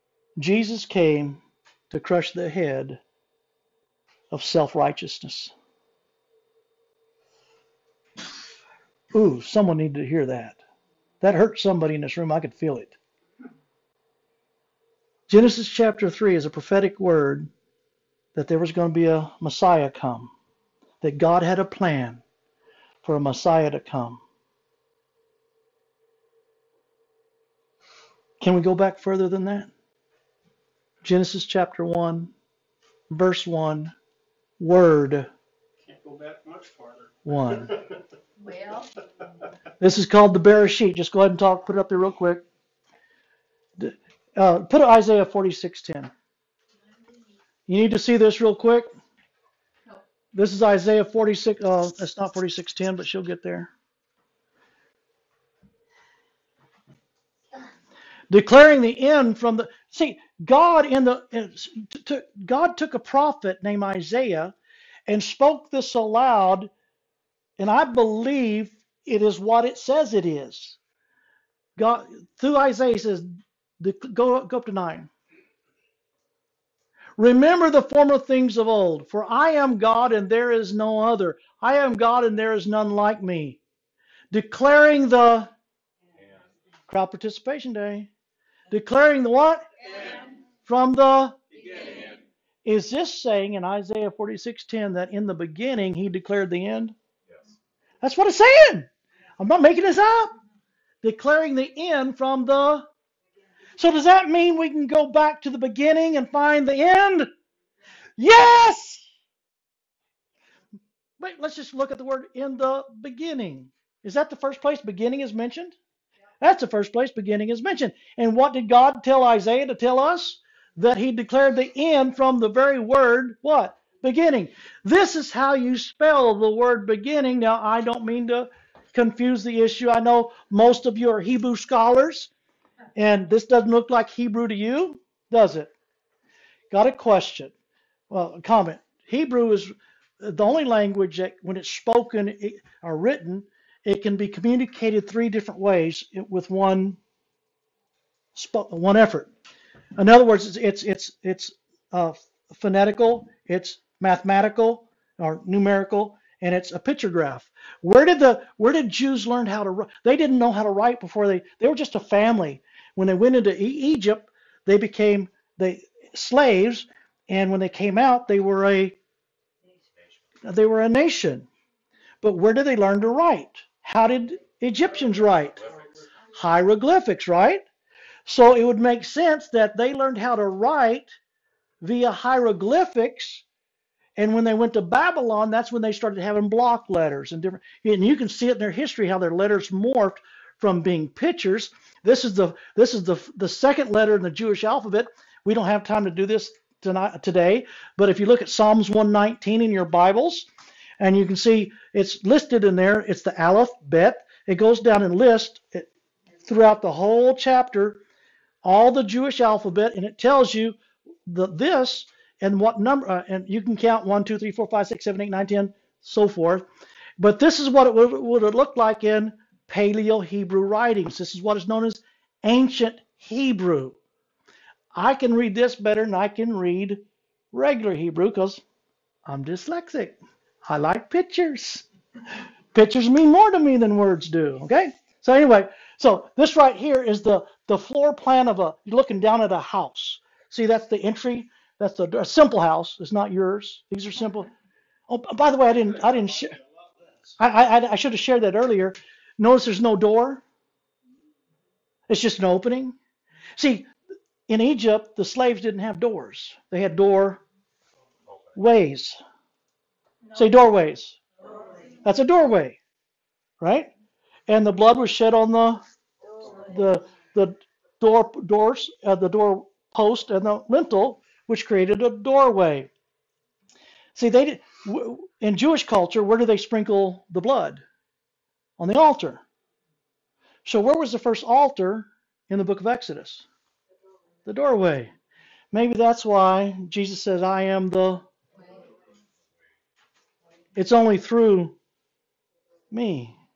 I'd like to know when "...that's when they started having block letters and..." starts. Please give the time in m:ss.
3:05.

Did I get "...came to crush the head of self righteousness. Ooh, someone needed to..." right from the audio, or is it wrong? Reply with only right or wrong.
right.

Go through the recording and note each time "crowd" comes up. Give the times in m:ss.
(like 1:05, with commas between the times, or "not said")
1:26.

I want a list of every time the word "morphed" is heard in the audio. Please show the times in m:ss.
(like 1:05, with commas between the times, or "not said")
3:09.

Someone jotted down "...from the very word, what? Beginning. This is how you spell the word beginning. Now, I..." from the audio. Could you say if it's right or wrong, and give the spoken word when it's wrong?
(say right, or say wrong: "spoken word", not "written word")
right.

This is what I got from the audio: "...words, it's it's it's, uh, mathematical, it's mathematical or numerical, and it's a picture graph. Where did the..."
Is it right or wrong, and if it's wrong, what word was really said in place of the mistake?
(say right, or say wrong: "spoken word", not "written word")
wrong: "phonetical", not "mathematical".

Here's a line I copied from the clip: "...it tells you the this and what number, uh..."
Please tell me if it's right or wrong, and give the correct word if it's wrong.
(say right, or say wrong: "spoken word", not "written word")
right.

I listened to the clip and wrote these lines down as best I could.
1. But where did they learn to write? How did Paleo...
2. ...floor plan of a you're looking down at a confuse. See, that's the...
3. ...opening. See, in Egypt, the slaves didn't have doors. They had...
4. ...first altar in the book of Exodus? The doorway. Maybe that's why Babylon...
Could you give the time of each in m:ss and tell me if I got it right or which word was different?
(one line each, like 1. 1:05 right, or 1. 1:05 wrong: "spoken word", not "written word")
1. 2:52 wrong: "Egyptians", not "Paleo"
2. 3:57 wrong: "house", not "confuse"
3. 4:12 right
4. 4:41 wrong: "Jesus", not "Babylon".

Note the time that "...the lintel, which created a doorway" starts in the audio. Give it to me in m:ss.
4:30.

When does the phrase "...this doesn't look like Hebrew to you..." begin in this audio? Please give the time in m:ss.
2:13.